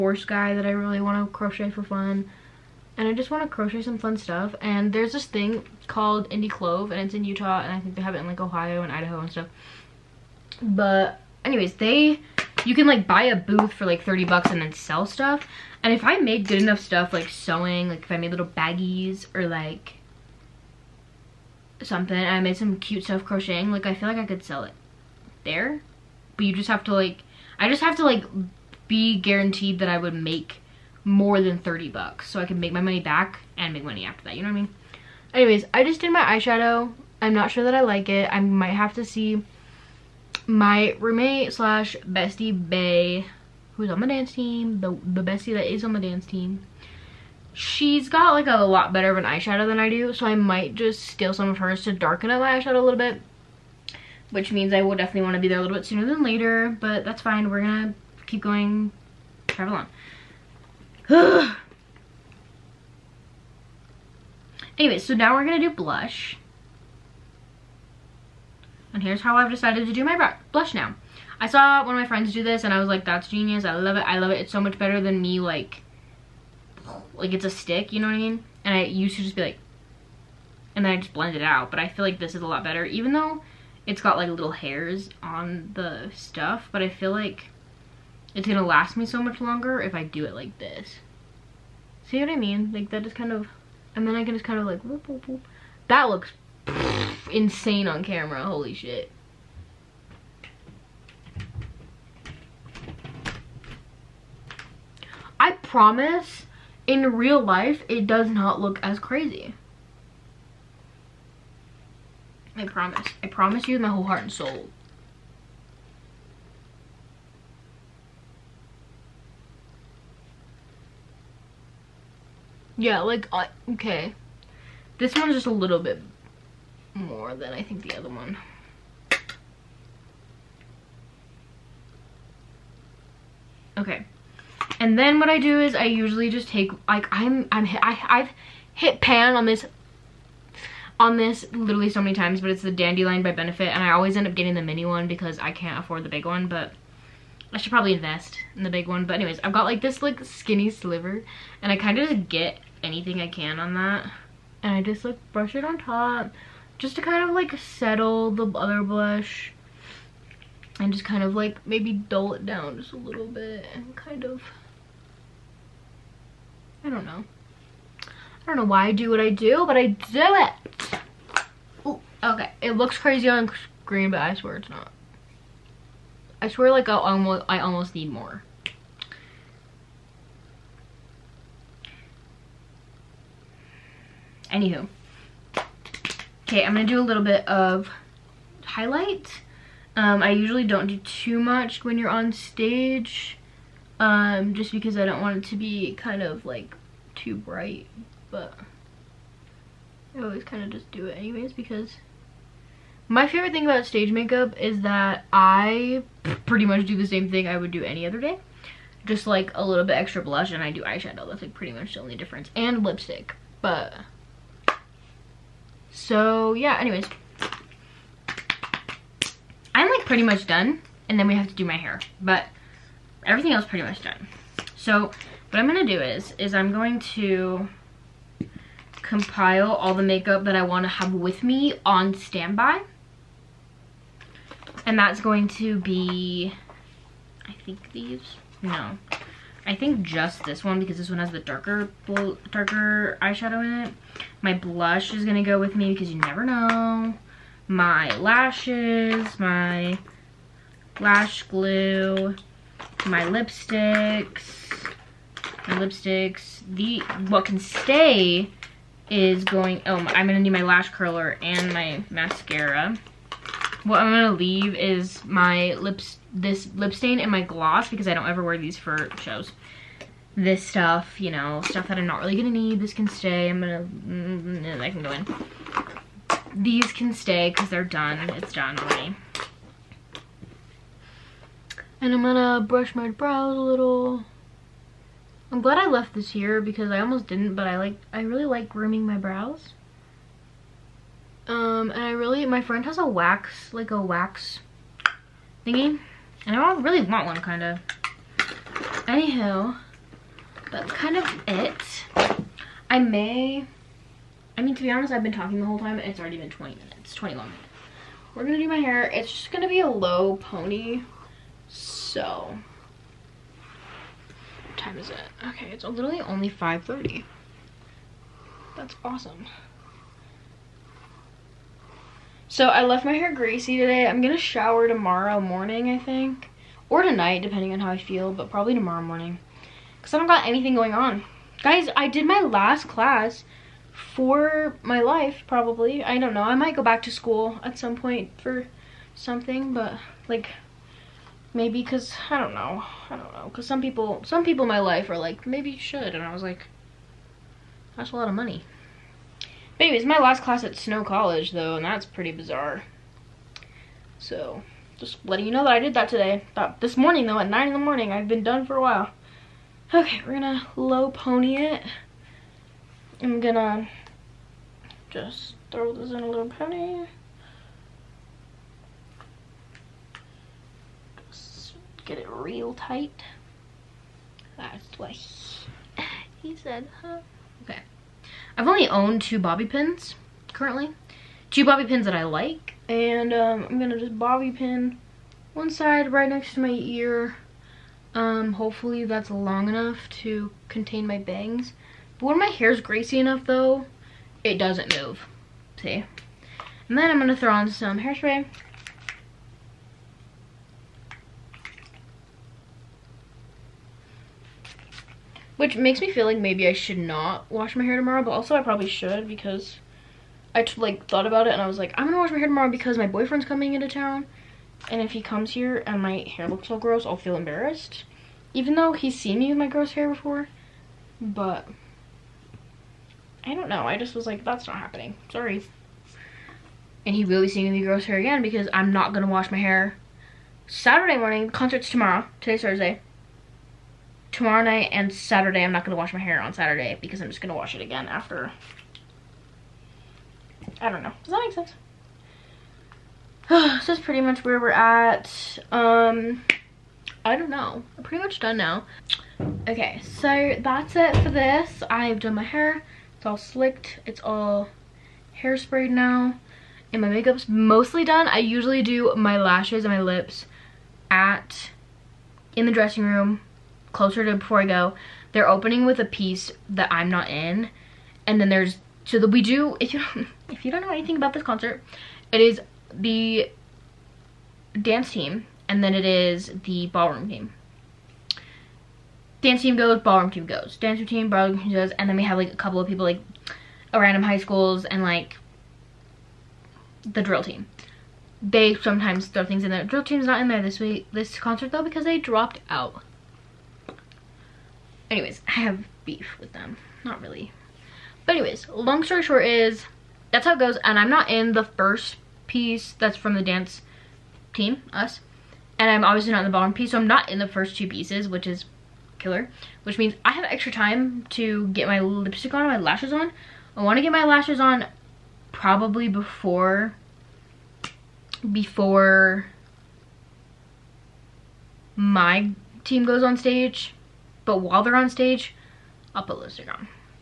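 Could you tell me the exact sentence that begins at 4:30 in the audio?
This stuff, you know, stuff that I'm not really gonna need, this can stay.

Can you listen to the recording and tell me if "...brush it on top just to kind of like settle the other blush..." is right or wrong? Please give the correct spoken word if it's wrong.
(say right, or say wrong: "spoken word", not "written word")
right.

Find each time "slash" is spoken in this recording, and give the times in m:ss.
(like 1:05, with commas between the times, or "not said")
0:41.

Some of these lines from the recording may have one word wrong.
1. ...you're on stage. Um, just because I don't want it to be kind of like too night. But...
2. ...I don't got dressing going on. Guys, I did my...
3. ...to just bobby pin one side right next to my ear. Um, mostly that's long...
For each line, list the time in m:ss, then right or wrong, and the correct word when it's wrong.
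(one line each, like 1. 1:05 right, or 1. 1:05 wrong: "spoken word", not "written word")
1. 3:11 wrong: "bright", not "night"
2. 5:30 wrong: "anything", not "dressing"
3. 6:23 wrong: "hopefully", not "mostly".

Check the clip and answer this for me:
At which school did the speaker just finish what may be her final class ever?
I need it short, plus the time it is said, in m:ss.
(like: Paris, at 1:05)
Snow College, at 5:50.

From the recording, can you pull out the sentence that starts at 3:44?
So what I'm gonna do is, is I'm going to compile all the makeup that I wanna have with me on standby.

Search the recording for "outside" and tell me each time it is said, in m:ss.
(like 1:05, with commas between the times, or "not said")
not said.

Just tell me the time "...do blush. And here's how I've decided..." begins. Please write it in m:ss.
1:05.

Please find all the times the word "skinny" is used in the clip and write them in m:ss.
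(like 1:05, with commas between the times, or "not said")
2:30.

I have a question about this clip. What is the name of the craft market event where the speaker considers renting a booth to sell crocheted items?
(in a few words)
Indie Clove.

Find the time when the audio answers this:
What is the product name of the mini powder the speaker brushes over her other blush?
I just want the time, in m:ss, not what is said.
2:22.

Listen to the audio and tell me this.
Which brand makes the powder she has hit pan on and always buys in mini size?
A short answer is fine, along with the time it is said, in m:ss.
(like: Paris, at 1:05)
Benefit, at 2:23.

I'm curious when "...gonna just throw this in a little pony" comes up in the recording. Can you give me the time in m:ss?
6:03.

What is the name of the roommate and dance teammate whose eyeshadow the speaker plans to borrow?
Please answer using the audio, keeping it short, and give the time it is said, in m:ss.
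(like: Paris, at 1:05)
Bay, at 0:42.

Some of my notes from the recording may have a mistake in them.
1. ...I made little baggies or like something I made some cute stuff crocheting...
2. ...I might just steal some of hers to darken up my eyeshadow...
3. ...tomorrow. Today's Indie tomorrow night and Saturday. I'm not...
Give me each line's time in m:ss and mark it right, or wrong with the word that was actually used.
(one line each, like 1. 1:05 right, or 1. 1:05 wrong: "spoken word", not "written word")
1. 0:18 right
2. 0:50 right
3. 7:11 wrong: "Thursday", not "Indie".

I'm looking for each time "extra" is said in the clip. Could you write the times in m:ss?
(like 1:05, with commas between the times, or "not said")
3:29, 8:30.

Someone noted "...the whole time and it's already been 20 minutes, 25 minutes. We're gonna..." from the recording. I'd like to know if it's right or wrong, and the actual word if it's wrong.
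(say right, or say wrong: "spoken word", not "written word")
wrong: "21", not "25".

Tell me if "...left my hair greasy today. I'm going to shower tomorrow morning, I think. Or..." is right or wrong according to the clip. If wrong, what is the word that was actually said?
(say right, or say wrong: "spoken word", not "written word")
right.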